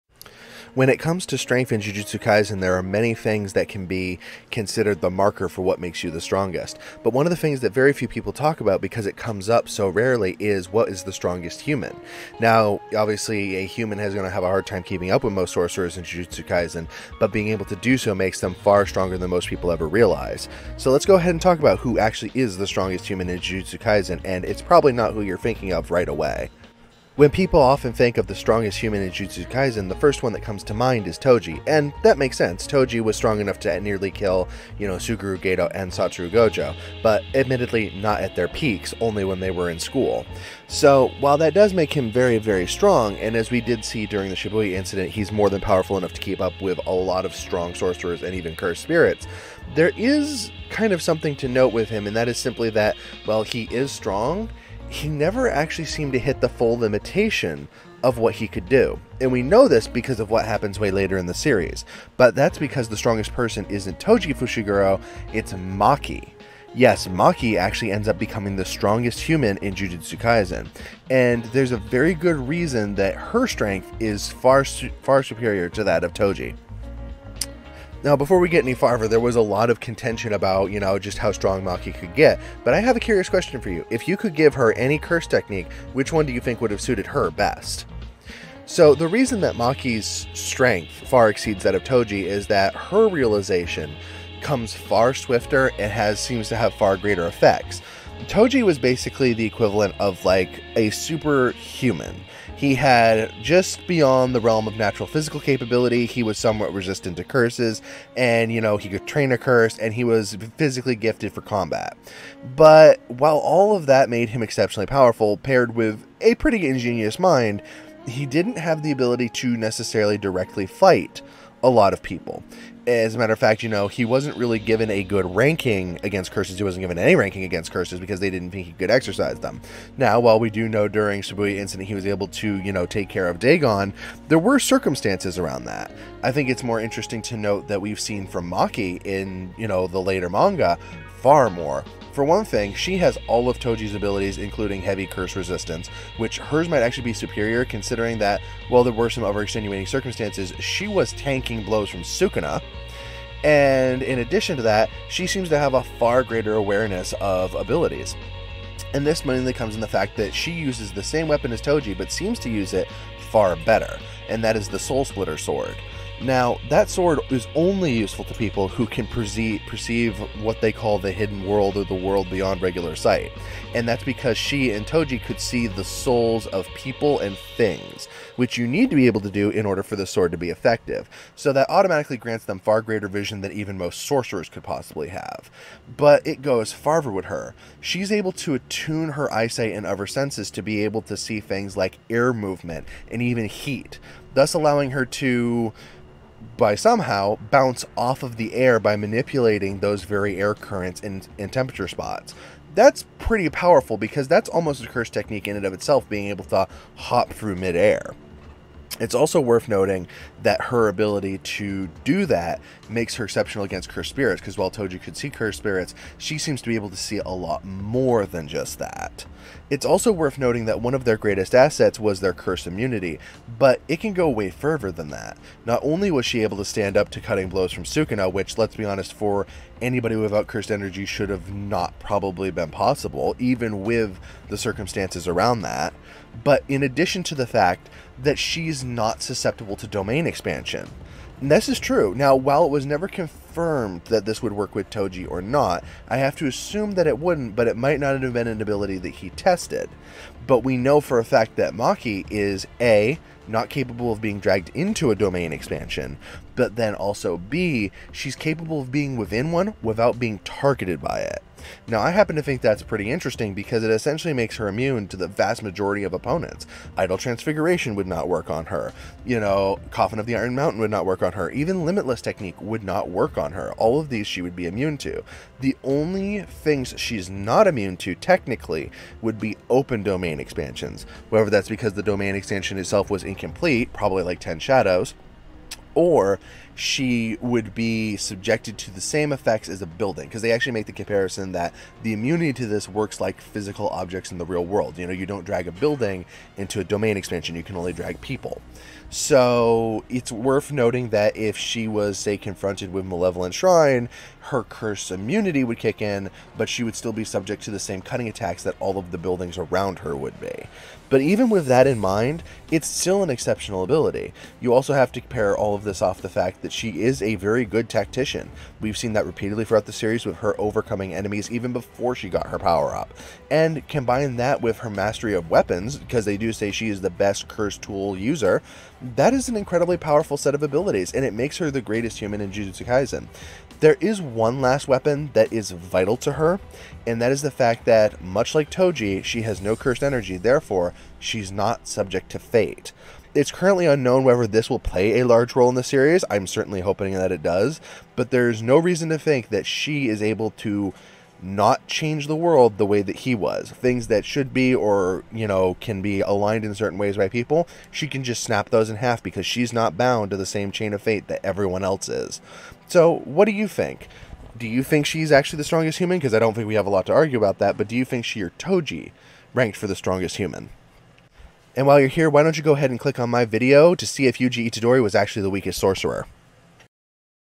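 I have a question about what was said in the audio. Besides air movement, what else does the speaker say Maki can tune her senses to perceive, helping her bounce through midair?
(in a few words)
Heat.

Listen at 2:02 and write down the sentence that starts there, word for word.
As a matter of fact, you know, he wasn't really given a good ranking against curses.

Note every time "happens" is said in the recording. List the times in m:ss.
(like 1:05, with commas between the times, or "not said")
1:00, 4:22.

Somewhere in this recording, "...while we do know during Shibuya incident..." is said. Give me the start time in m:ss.
2:10.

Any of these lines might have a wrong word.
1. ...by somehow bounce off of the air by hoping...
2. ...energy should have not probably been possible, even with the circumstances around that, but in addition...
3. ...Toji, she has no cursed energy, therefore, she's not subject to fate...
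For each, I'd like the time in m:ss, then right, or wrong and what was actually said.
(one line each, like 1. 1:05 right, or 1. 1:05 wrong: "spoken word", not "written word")
1. 3:16 wrong: "manipulating", not "hoping"
2. 3:50 right
3. 5:38 right.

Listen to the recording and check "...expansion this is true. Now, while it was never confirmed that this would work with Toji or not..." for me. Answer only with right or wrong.
right.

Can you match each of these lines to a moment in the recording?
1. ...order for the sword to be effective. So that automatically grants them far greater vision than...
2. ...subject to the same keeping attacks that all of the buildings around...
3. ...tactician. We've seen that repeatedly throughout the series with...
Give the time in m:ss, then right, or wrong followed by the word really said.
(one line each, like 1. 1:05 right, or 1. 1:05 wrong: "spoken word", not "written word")
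1. 2:59 right
2. 5:07 wrong: "cutting", not "keeping"
3. 5:17 right.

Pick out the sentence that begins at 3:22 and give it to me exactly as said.
That's pretty powerful because that's almost a curse technique in and of itself, being able to hop through midair.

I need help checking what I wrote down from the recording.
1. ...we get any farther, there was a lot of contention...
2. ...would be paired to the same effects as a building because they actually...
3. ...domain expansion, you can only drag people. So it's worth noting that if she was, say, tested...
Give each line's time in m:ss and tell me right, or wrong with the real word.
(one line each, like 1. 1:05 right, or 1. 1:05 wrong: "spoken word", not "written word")
1. 1:18 right
2. 4:47 wrong: "subjected", not "paired"
3. 4:56 wrong: "confronted", not "tested".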